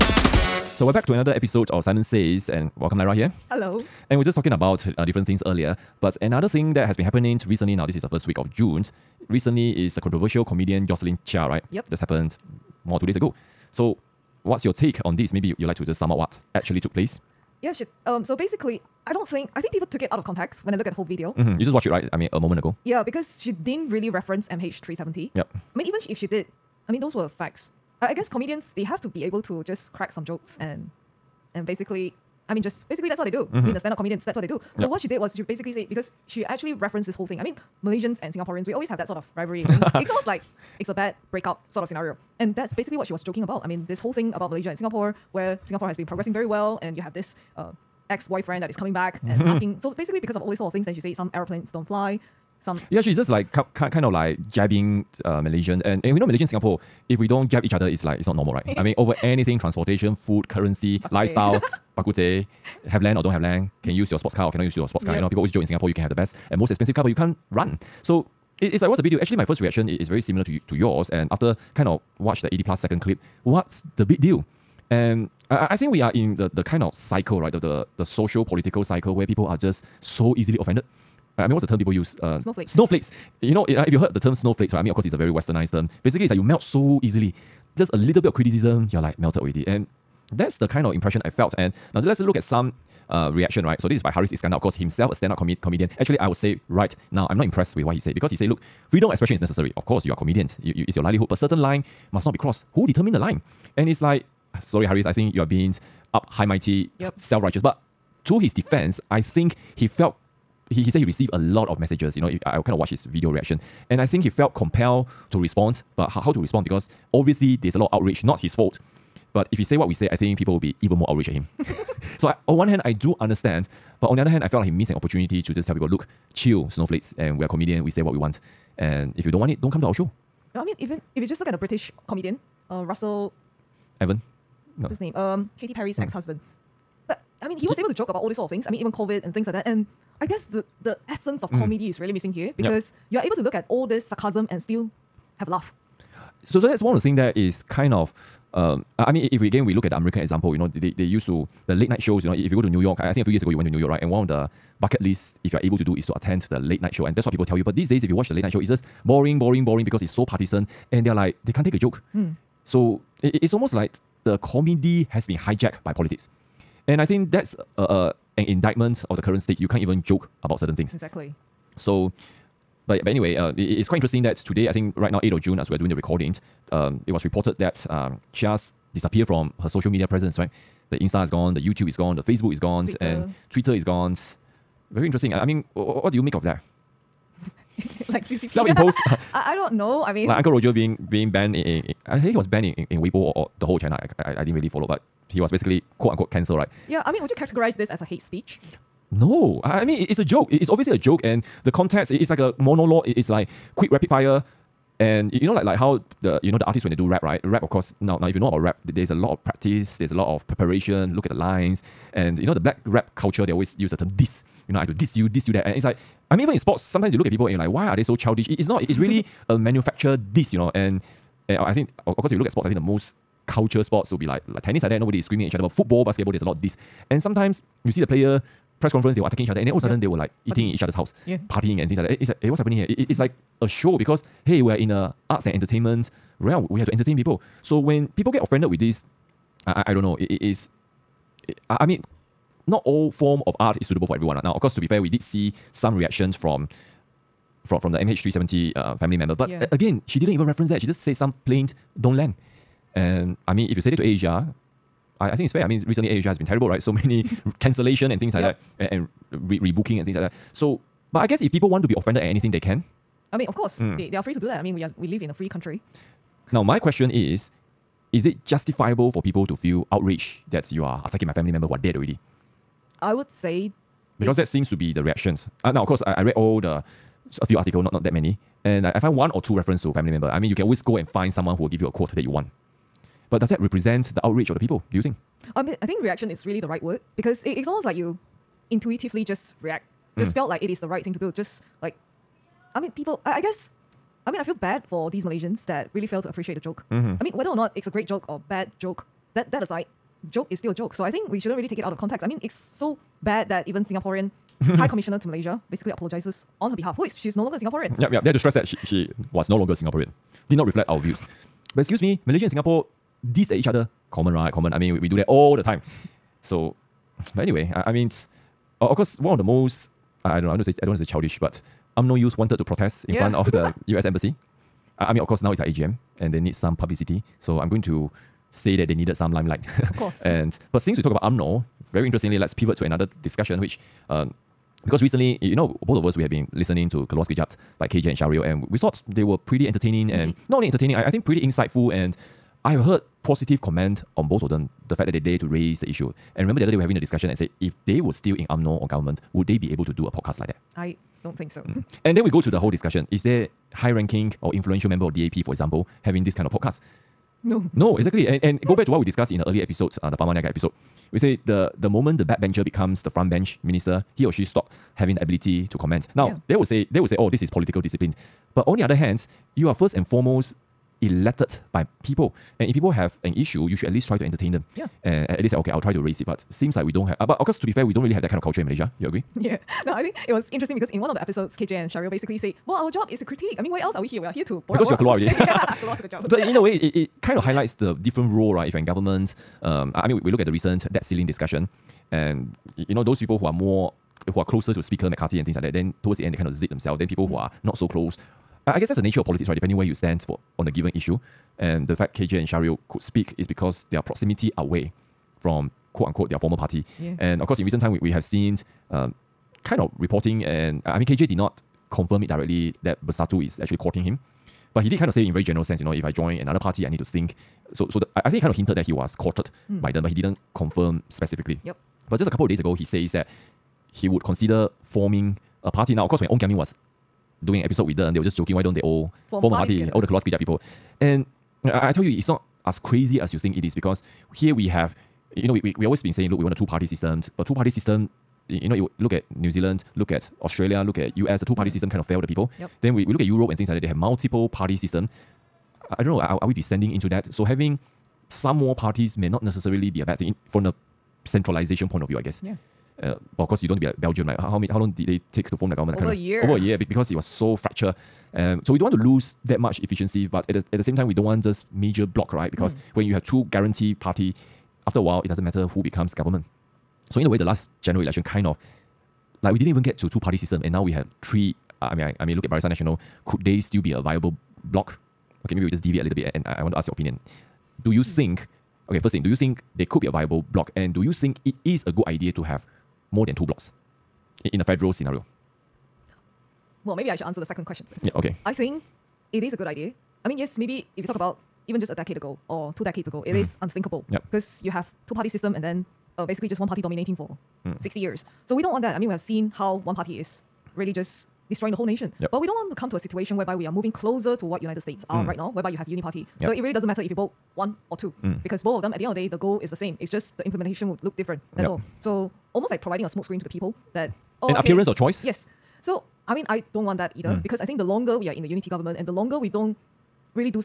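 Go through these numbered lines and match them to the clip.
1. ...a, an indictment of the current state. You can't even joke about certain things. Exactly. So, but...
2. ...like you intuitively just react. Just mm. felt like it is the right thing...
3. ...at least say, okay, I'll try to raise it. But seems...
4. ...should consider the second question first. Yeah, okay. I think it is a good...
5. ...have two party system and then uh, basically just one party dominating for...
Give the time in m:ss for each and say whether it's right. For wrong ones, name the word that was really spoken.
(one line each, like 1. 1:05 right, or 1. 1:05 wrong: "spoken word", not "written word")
1. 2:47 right
2. 4:47 right
3. 6:15 right
4. 8:07 wrong: "answer", not "consider"
5. 8:14 right.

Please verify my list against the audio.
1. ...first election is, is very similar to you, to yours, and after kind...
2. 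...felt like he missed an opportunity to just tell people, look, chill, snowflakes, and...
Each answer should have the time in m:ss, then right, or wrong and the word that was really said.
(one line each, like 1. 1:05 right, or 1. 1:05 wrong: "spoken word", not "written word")
1. 1:09 wrong: "reaction", not "election"
2. 2:04 right.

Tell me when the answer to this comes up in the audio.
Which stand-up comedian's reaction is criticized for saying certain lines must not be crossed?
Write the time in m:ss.
1:34.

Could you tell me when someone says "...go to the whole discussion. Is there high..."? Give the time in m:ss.
5:52.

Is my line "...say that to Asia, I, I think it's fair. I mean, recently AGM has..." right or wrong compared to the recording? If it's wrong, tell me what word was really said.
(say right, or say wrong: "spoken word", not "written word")
wrong: "Asia", not "AGM".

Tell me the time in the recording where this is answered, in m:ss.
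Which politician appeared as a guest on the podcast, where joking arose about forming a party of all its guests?
7:06.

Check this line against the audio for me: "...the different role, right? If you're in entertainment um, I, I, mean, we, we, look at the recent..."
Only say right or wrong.
wrong.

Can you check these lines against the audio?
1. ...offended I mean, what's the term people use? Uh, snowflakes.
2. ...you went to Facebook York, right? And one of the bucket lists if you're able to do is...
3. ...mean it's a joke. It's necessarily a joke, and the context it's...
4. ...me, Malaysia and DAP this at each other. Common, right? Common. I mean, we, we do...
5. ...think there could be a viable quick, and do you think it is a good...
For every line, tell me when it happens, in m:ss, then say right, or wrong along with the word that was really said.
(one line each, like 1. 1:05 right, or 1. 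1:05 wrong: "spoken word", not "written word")
1. 1:20 right
2. 2:33 wrong: "New", not "Facebook"
3. 3:19 wrong: "obviously", not "necessarily"
4. 5:12 wrong: "Singapore", not "DAP"
5. 7:59 wrong: "block", not "quick".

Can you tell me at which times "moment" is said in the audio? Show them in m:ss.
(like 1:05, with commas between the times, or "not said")
0:22, 6:01.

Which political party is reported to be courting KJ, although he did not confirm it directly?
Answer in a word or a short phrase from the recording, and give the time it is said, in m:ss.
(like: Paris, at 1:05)
Bersatu, at 6:53.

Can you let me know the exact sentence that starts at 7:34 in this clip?
Like how how, many, how long did they take to form the government?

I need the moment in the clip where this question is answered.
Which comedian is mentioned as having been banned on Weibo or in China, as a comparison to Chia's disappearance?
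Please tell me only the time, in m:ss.
3:10.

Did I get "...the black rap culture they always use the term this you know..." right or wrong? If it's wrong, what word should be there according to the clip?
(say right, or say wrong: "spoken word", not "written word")
right.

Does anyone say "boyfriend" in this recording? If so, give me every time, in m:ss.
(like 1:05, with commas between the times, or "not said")
0:48.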